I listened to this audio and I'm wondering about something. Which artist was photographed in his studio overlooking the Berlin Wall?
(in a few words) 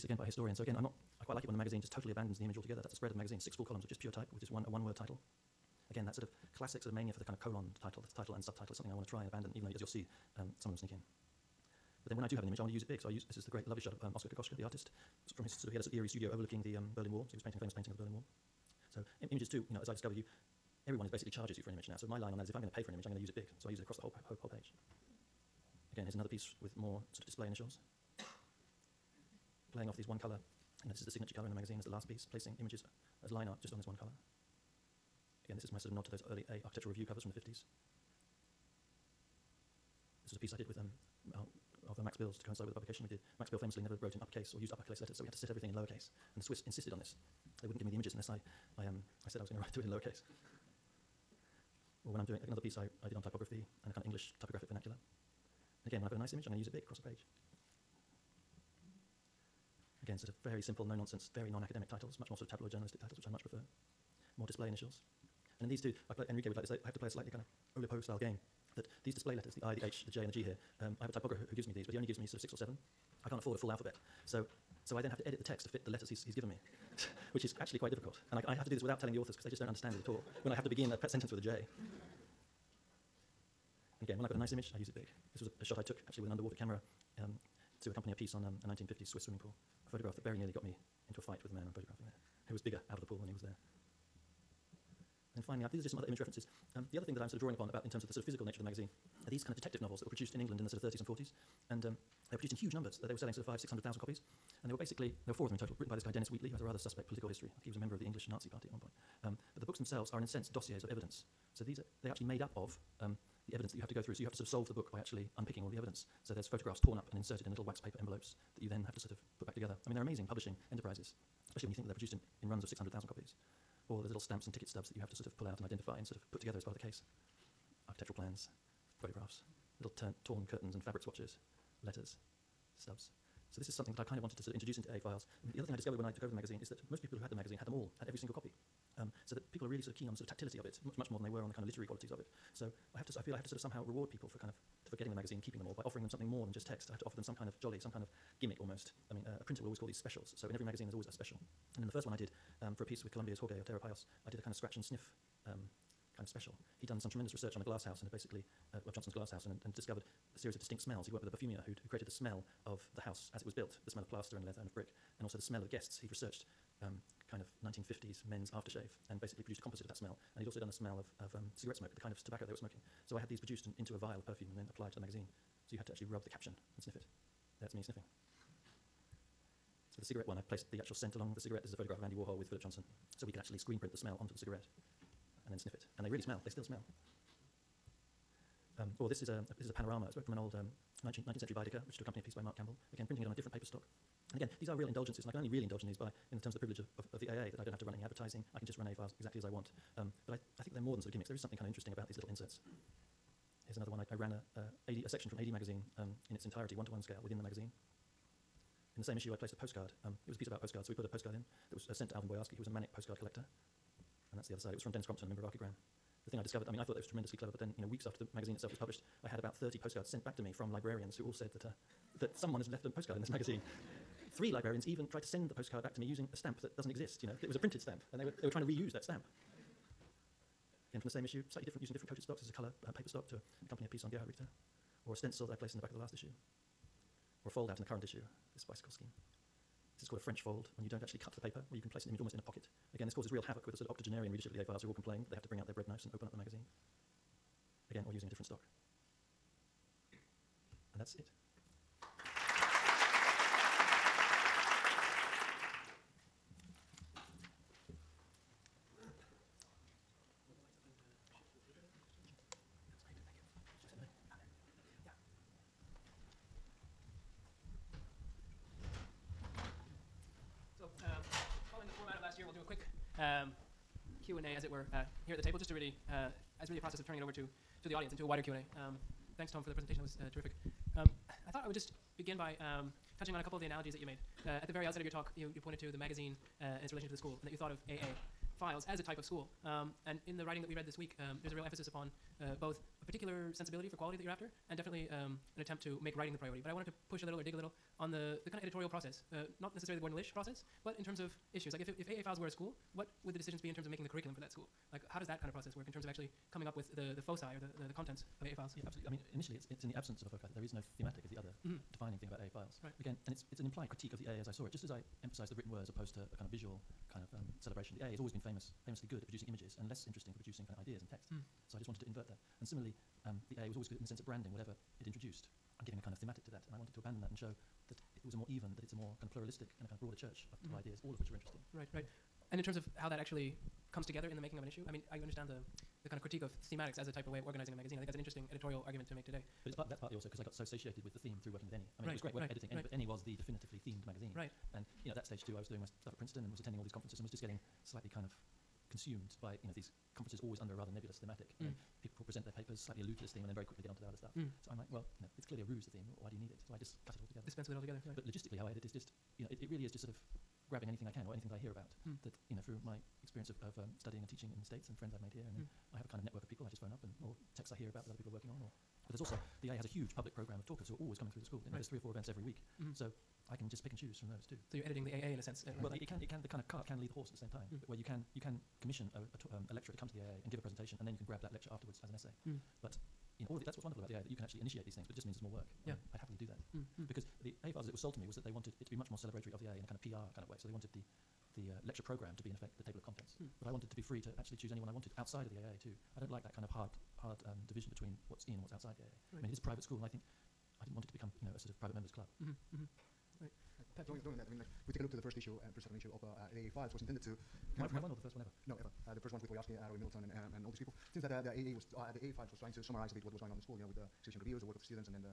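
Oscar Kokoschka.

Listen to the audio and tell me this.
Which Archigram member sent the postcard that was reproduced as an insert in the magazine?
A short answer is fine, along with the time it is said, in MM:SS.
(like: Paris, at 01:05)
Dennis Crompton, at 03:34.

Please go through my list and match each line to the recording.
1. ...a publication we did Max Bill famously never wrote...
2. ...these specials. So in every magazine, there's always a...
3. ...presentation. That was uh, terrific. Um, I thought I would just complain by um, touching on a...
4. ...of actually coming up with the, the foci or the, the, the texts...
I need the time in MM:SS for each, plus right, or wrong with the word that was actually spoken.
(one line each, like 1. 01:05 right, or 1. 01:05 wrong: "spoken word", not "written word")
1. 00:42 right
2. 02:29 right
3. 04:39 wrong: "begin", not "complain"
4. 05:06 wrong: "contents", not "texts".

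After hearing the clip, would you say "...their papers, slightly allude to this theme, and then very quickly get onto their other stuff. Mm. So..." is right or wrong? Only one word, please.
right.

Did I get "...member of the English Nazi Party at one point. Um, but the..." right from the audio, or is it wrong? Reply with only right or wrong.
right.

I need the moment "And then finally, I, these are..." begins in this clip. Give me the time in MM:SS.
01:35.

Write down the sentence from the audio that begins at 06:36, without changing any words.
I don't like that kind of hard, hard um, division between what's in and what's outside the AA.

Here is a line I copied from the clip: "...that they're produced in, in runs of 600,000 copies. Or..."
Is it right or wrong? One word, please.
right.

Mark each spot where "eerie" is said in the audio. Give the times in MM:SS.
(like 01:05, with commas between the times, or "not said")
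00:15.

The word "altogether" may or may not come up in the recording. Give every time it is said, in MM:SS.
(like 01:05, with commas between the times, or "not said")
00:02, 05:57.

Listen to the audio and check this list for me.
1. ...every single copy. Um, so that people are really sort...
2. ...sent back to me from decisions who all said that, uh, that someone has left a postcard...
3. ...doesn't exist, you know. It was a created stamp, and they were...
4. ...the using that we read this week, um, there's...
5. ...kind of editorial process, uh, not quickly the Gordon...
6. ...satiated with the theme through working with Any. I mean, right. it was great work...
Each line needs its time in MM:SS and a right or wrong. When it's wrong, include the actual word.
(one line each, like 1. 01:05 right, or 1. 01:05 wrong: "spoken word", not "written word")
1. 02:18 right
2. 03:40 wrong: "librarians", not "decisions"
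3. 03:46 wrong: "printed", not "created"
4. 04:50 wrong: "writing", not "using"
5. 04:58 wrong: "necessarily", not "quickly"
6. 05:40 right.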